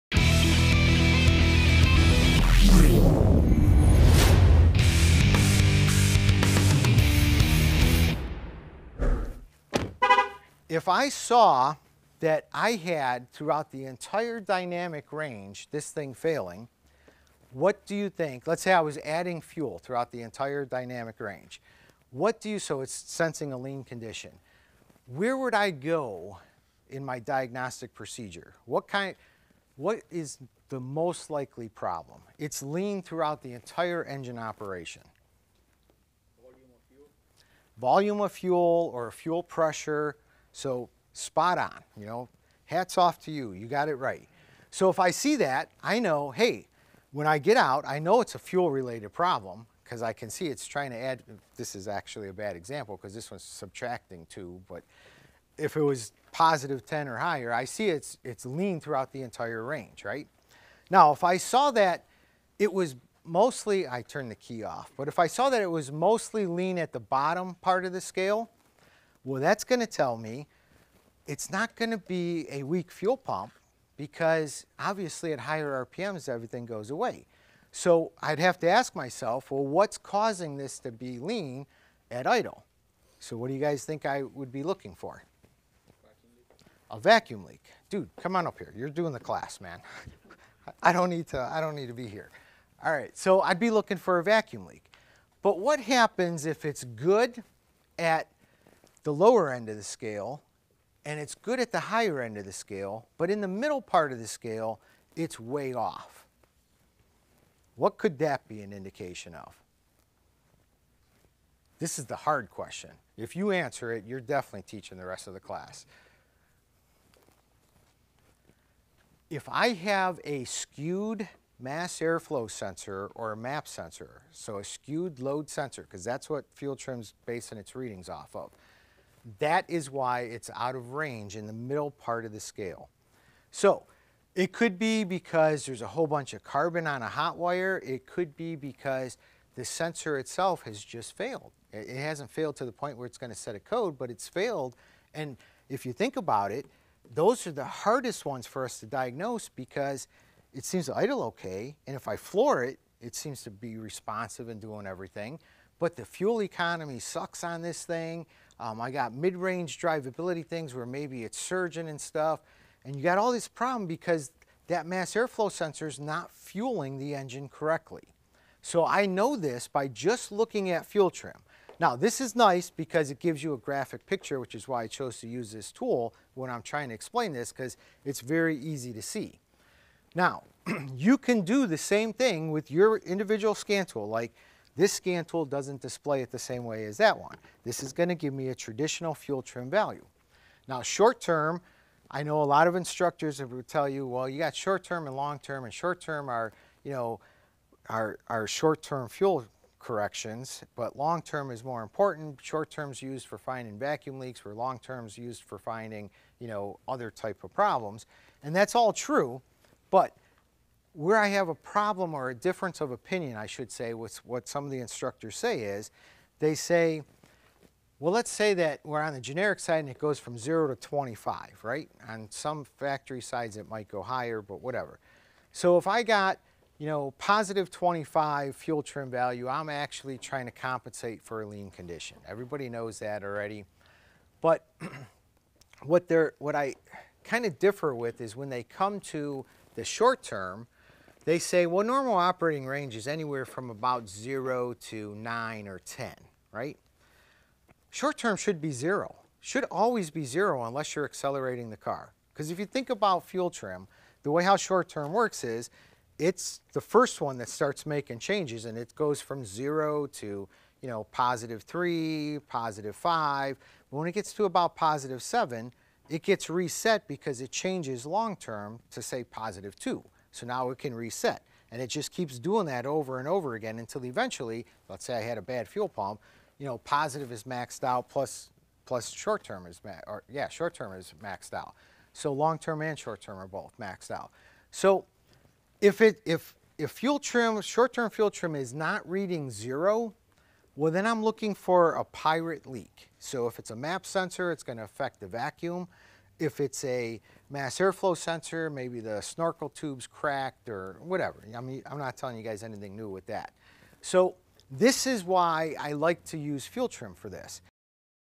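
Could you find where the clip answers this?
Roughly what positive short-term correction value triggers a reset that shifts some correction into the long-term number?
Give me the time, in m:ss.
4:24.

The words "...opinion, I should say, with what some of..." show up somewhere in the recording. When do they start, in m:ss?
3:32.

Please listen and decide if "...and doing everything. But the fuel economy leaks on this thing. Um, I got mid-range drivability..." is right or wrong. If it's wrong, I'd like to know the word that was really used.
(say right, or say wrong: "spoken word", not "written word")
wrong: "sucks", not "leaks".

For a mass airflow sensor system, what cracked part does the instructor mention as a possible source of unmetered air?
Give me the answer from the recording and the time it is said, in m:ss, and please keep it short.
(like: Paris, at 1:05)
Snorkel tube, at 4:59.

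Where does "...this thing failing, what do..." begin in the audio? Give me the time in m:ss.
0:15.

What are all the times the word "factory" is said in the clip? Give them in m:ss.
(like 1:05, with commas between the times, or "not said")
3:42.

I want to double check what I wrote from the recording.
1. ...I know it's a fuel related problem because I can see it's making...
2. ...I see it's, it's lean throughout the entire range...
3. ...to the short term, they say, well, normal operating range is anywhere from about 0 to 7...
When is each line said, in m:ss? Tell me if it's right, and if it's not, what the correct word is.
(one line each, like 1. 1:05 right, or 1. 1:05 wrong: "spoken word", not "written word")
1. 0:47 wrong: "trying", not "making"
2. 0:57 right
3. 3:59 wrong: "9", not "7".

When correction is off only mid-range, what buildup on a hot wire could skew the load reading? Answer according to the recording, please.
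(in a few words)
Carbon.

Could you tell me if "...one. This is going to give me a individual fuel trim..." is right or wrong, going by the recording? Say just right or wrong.
wrong.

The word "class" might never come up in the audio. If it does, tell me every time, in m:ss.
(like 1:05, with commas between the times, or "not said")
1:29, 1:55.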